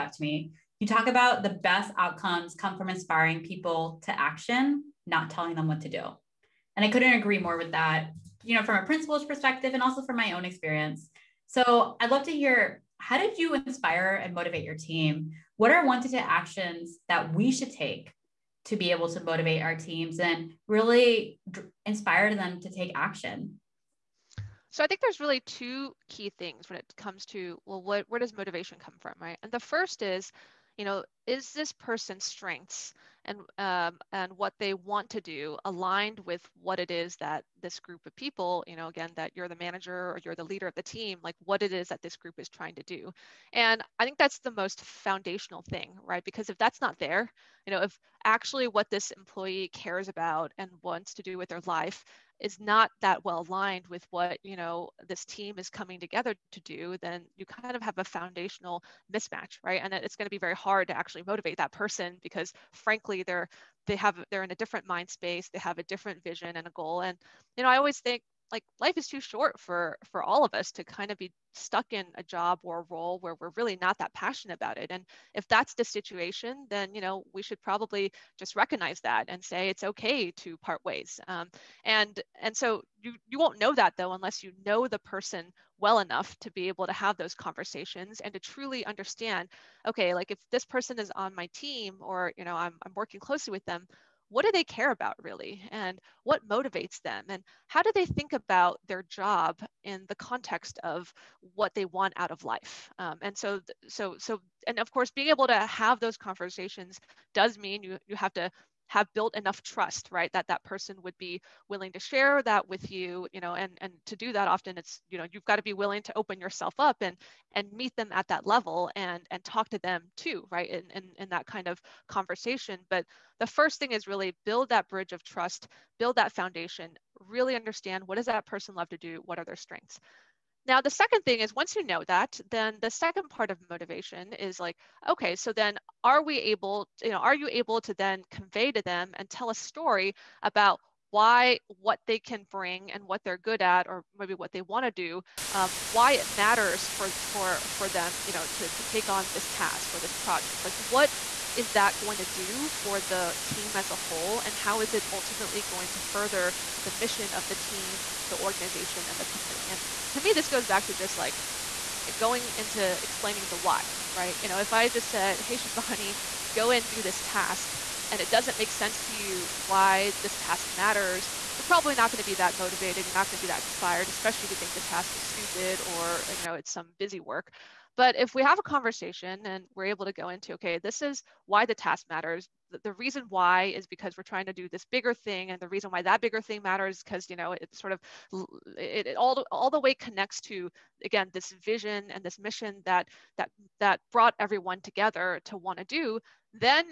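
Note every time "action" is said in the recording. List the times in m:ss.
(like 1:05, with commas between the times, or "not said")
0:04, 0:16, 0:22.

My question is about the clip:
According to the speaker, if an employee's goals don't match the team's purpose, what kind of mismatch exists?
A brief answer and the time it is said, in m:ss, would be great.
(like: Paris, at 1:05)
foundational mismatch, at 0:58.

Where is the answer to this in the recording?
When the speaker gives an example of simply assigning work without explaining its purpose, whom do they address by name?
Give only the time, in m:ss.
2:45.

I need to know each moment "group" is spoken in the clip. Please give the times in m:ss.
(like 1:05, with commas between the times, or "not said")
0:37, 0:42.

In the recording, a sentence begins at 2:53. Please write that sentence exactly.
You're not going to be that inspired, especially if you think the task is stupid or, you know, it's some busy work.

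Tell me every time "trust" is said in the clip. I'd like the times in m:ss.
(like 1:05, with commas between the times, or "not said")
1:49, 2:05.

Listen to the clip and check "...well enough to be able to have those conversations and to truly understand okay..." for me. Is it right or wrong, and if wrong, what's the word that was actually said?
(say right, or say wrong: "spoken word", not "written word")
right.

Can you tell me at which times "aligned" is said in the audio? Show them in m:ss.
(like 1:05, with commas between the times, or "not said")
0:35, 0:53.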